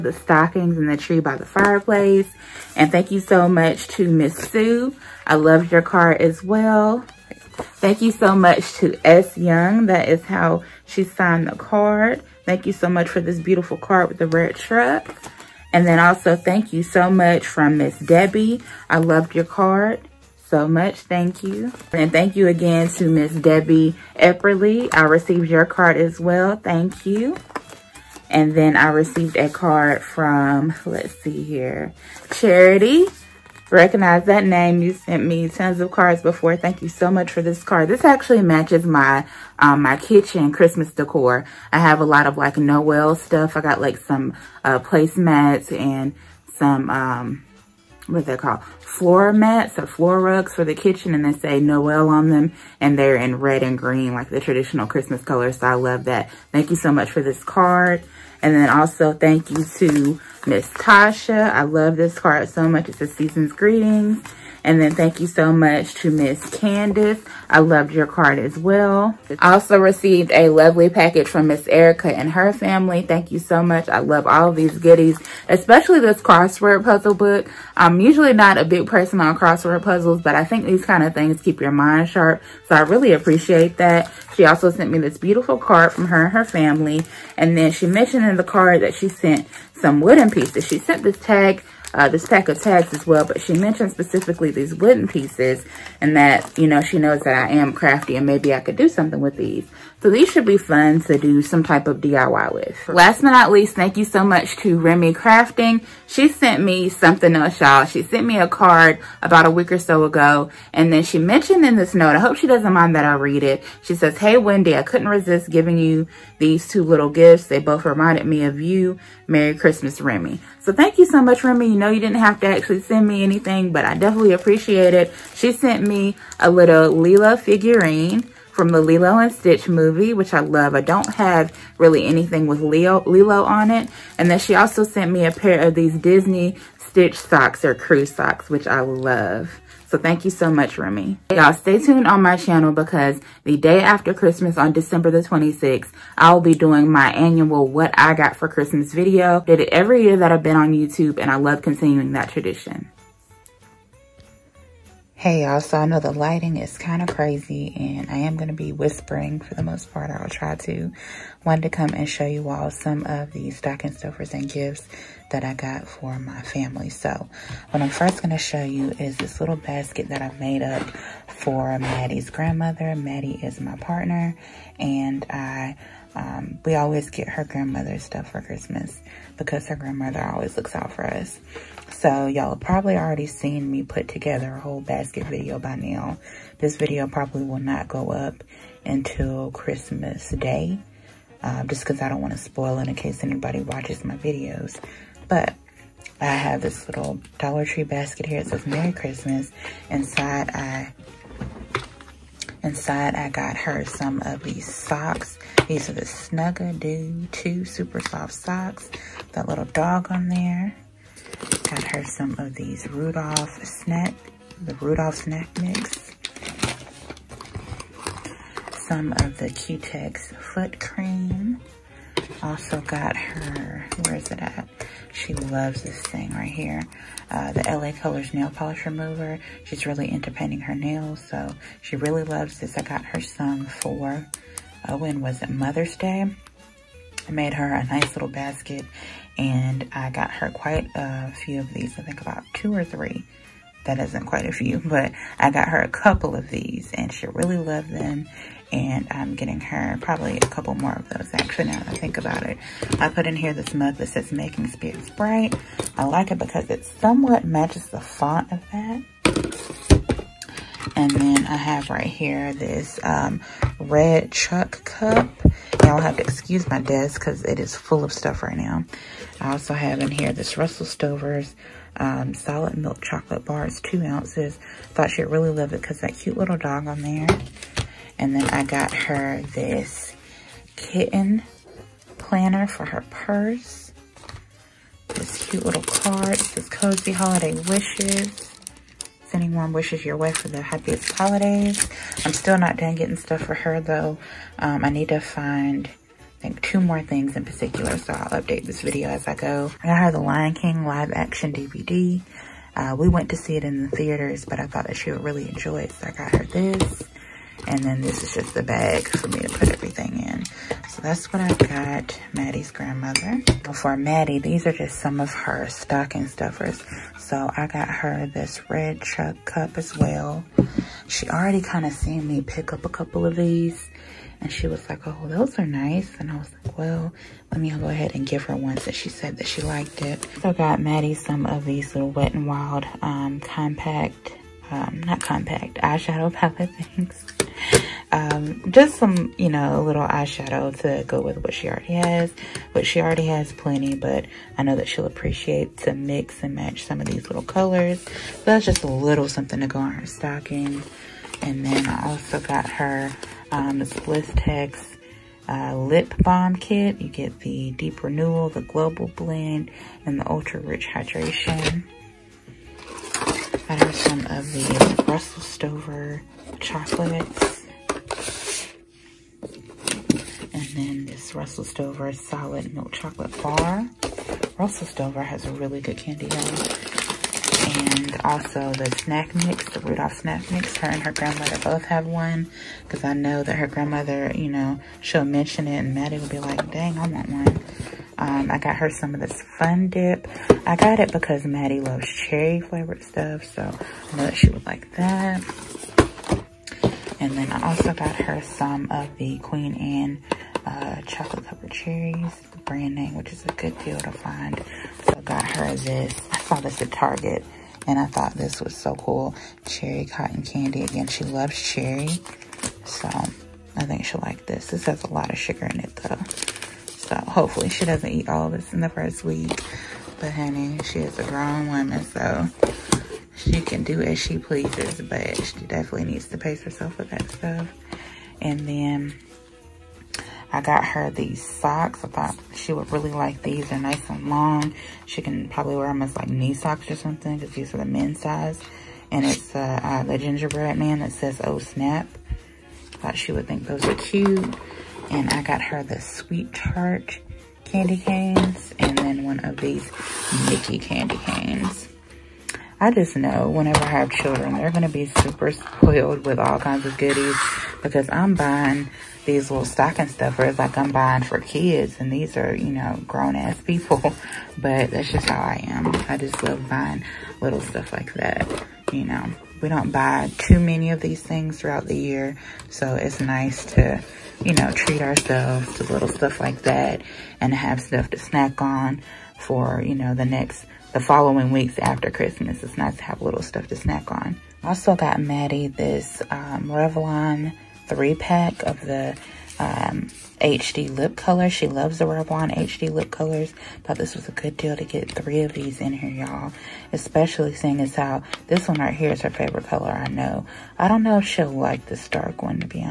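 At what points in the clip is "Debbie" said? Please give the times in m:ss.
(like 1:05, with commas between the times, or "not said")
0:17, 0:23.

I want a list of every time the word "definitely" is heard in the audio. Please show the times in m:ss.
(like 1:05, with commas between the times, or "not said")
2:03, 7:05.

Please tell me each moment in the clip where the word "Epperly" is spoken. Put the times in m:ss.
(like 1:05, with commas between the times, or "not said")
0:24.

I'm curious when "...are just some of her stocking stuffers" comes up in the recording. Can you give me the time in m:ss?
5:14.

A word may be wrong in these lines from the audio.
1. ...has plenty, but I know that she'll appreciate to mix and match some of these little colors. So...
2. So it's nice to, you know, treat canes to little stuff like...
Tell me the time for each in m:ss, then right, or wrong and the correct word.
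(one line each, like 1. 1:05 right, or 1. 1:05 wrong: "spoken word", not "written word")
1. 5:43 right
2. 7:52 wrong: "ourselves", not "canes".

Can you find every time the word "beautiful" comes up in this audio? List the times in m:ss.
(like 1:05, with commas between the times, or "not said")
0:13, 1:25.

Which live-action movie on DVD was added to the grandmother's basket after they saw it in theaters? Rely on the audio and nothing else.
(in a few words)
The Lion King.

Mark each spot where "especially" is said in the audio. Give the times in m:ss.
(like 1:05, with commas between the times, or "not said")
1:15, 8:16.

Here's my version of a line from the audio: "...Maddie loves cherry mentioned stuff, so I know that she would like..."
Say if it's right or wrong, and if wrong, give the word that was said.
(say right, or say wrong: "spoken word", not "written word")
wrong: "flavored", not "mentioned".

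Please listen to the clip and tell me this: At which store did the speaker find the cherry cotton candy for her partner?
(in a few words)
Target.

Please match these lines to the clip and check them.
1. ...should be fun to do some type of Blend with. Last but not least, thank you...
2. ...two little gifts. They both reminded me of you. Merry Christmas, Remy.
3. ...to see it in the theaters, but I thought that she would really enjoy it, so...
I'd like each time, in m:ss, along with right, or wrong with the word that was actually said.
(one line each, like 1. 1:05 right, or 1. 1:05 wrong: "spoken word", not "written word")
1. 1:40 wrong: "DIY", not "Blend"
2. 1:56 right
3. 5:03 right.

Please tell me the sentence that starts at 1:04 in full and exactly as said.
And then thank you so much to Miss Candace.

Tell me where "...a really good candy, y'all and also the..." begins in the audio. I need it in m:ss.
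6:15.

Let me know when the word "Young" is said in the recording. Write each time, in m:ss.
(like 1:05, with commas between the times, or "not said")
0:09.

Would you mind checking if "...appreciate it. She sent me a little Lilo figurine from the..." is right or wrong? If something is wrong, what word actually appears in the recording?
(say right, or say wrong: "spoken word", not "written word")
right.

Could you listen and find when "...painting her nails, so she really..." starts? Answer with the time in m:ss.
3:50.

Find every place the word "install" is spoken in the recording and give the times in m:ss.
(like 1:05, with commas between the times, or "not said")
not said.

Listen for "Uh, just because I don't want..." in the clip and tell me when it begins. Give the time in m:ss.
3:11.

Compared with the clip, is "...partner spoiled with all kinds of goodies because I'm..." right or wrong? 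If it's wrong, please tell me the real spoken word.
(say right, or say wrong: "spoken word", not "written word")
wrong: "super", not "partner".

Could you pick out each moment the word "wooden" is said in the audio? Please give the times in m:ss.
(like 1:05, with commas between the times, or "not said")
1:29, 1:34.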